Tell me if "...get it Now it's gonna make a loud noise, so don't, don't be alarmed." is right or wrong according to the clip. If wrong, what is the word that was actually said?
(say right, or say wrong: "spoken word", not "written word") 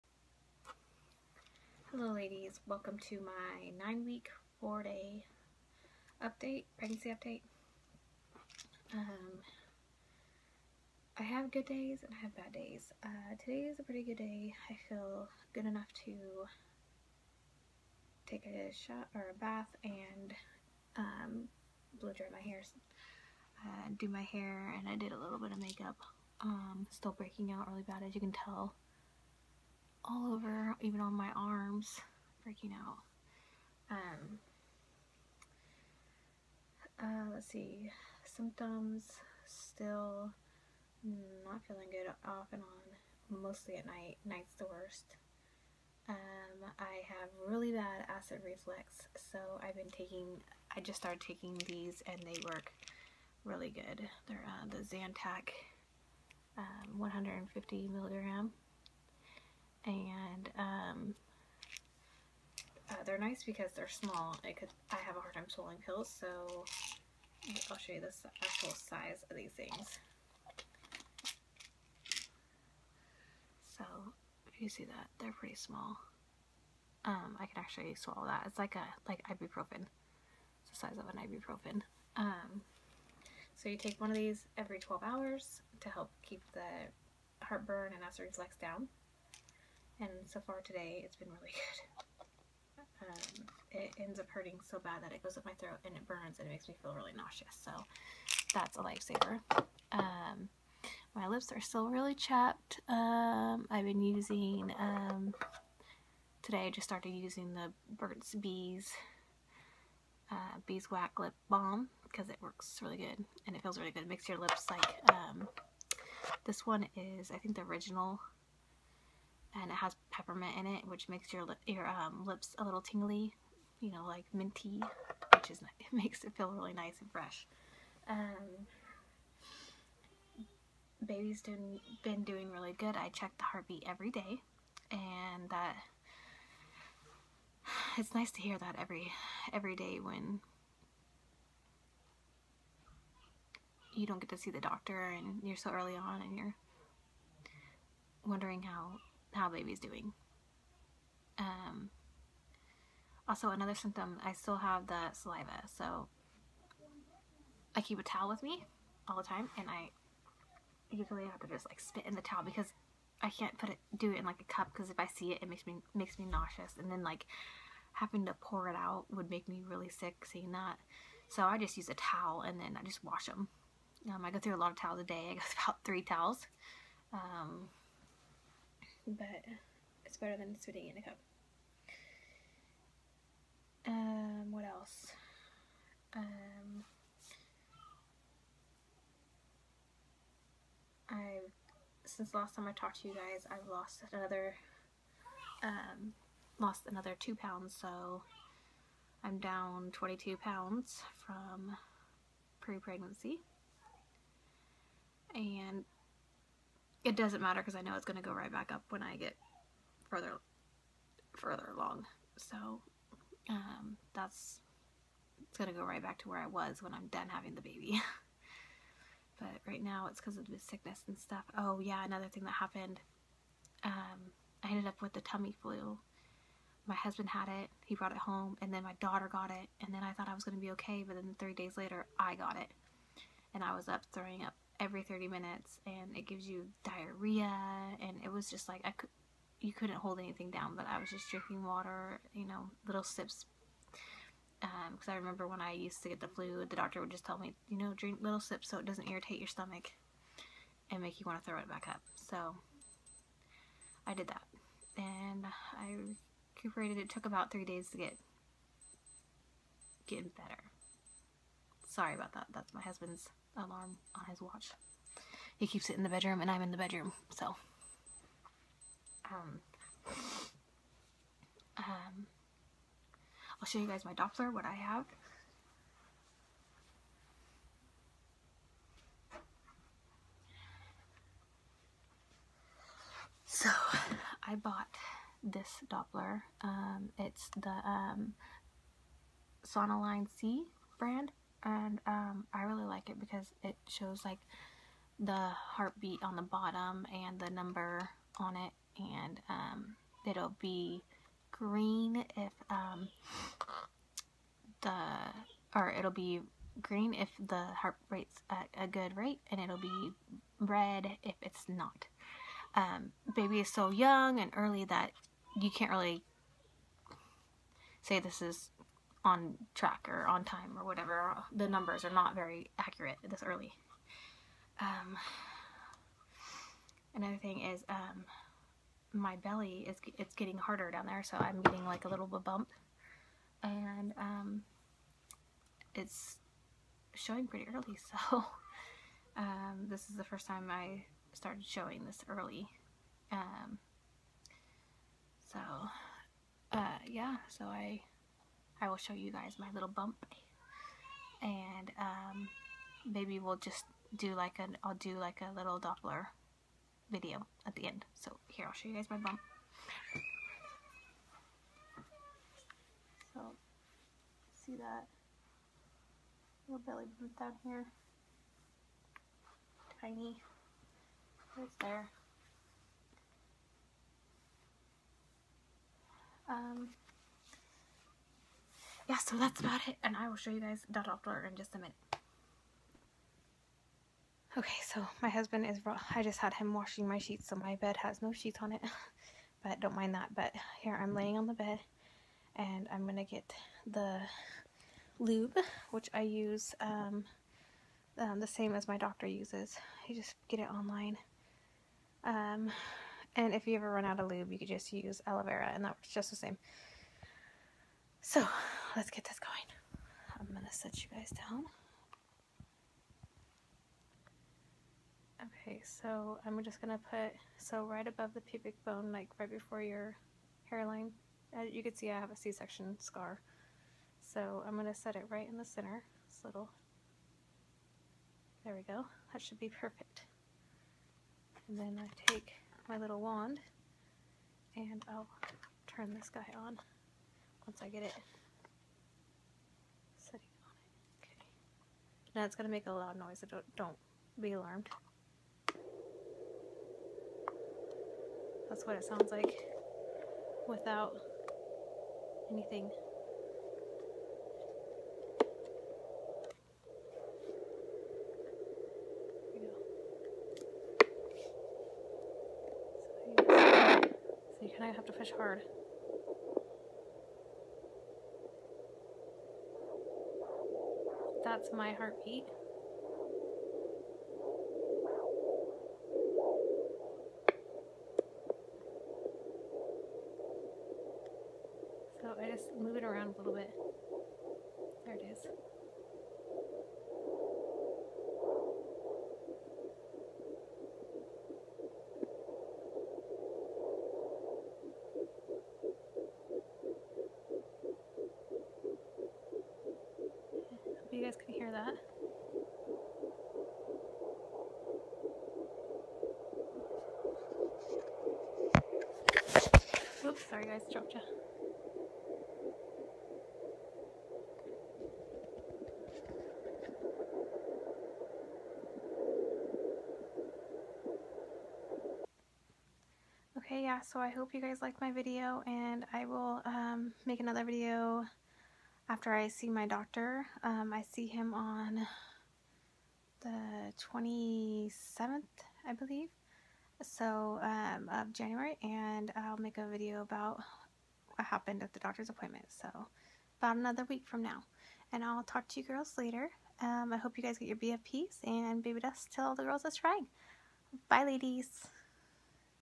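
right.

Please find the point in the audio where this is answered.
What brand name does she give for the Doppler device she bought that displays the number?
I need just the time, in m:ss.
4:49.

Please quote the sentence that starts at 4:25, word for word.
He keeps it in the bedroom, and I'm in the bedroom, so.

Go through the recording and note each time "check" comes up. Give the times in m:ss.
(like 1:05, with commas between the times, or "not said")
2:13.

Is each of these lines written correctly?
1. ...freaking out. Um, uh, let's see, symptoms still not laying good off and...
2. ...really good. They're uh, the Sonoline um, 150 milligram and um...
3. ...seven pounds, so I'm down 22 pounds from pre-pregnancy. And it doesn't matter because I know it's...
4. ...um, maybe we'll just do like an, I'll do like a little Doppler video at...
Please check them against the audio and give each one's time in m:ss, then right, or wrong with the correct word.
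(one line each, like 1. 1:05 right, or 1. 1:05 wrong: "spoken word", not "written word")
1. 0:32 wrong: "feeling", not "laying"
2. 0:53 wrong: "Zantac", not "Sonoline"
3. 3:17 wrong: "two", not "seven"
4. 5:51 right.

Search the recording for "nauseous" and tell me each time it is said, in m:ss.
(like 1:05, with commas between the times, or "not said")
1:37, 2:46.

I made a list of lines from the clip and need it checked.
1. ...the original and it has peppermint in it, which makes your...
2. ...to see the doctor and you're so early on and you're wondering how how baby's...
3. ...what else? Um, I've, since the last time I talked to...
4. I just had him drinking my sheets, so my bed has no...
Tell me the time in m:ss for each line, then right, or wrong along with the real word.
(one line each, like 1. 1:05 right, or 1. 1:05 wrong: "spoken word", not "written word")
1. 1:57 right
2. 2:24 right
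3. 3:04 right
4. 6:26 wrong: "washing", not "drinking".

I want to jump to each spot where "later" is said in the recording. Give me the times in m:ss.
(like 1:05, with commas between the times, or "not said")
3:51, 9:06.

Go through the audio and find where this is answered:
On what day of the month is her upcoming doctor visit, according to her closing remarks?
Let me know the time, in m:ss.
8:54.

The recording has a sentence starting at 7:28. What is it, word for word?
That's what it sounds like without anything.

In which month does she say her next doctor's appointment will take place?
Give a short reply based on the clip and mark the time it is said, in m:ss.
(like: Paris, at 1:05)
January, at 8:58.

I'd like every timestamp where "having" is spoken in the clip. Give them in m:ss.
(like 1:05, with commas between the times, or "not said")
2:47, 3:37.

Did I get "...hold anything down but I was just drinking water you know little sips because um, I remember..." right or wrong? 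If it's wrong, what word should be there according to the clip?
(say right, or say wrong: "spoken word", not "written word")
right.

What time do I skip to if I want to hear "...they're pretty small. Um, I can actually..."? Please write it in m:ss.
1:15.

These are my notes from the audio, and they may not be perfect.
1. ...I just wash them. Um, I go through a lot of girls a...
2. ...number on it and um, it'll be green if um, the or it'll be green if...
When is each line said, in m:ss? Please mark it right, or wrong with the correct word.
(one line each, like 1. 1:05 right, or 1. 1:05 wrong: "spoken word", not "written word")
1. 2:52 wrong: "towels", not "girls"
2. 4:57 right.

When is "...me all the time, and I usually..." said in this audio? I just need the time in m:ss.
2:38.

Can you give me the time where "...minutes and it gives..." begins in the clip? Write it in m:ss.
3:55.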